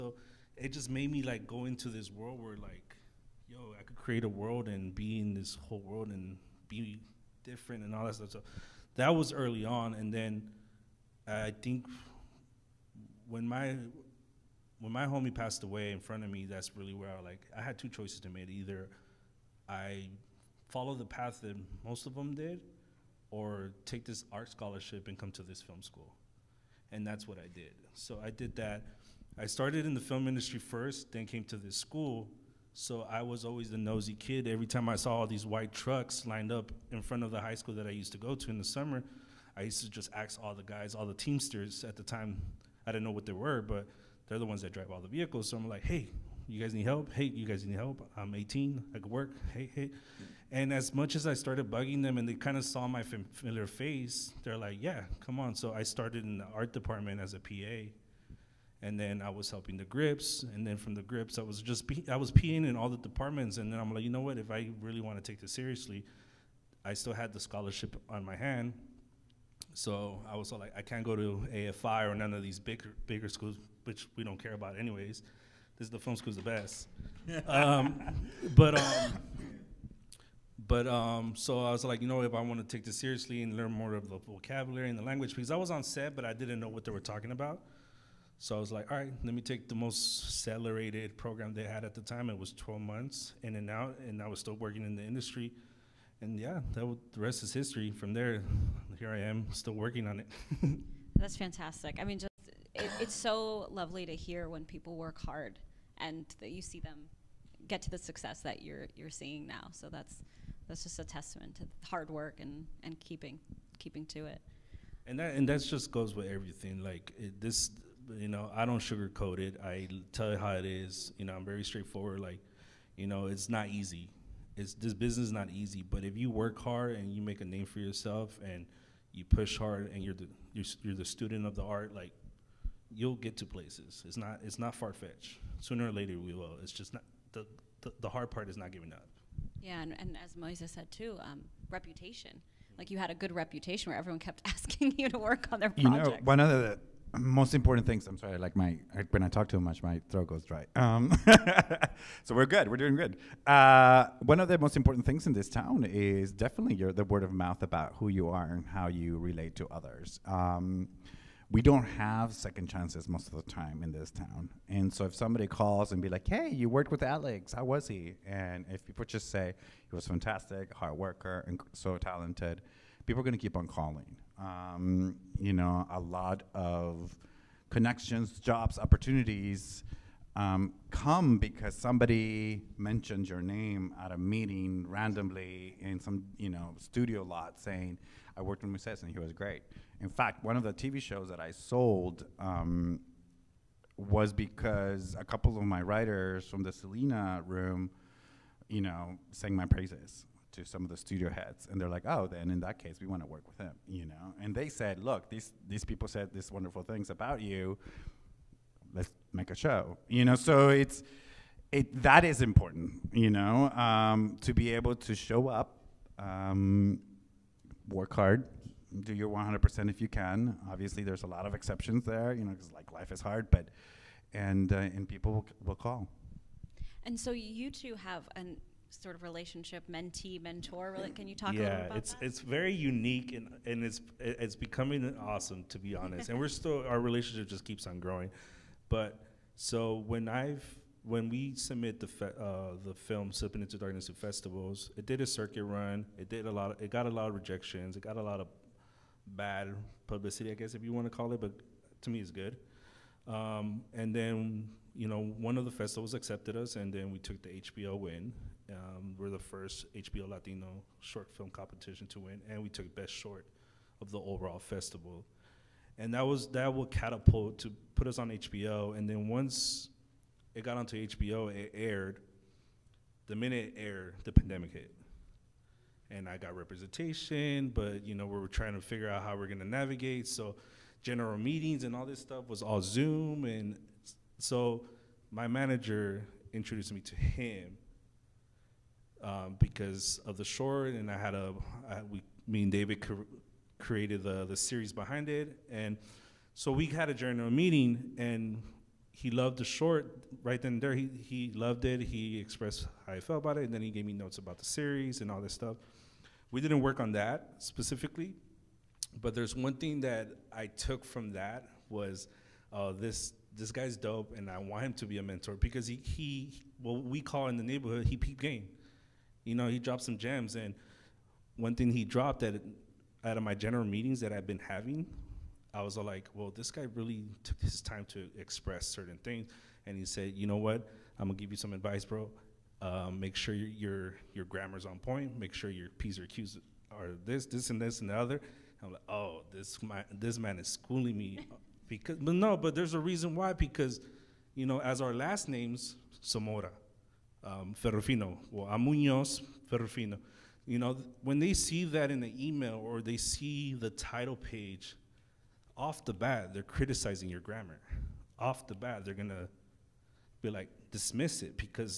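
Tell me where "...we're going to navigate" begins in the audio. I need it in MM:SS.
04:39.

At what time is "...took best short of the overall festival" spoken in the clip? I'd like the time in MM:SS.
04:22.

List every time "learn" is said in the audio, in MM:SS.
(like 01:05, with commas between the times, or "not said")
01:23.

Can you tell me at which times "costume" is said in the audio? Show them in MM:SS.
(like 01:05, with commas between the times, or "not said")
not said.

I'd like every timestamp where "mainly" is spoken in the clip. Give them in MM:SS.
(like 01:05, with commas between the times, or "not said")
not said.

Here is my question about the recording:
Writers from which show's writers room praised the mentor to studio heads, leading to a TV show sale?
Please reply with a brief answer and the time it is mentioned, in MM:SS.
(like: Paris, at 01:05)
Selena, at 03:16.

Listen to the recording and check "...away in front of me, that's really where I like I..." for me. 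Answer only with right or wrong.
right.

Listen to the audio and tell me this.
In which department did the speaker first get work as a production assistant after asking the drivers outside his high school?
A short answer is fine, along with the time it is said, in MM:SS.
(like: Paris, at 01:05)
art department, at 00:56.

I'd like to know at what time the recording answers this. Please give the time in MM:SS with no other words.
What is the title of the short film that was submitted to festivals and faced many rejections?
04:03.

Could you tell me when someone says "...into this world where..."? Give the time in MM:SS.
00:01.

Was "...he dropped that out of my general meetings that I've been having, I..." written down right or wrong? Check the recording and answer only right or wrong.
right.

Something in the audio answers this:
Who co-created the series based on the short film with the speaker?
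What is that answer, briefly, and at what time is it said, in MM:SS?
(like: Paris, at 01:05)
David, at 04:52.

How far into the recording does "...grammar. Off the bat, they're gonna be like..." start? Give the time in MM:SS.
05:57.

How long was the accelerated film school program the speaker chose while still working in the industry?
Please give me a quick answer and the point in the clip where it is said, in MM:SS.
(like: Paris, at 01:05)
12 months, at 01:32.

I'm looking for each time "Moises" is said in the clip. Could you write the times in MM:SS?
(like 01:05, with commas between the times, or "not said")
02:20, 03:08.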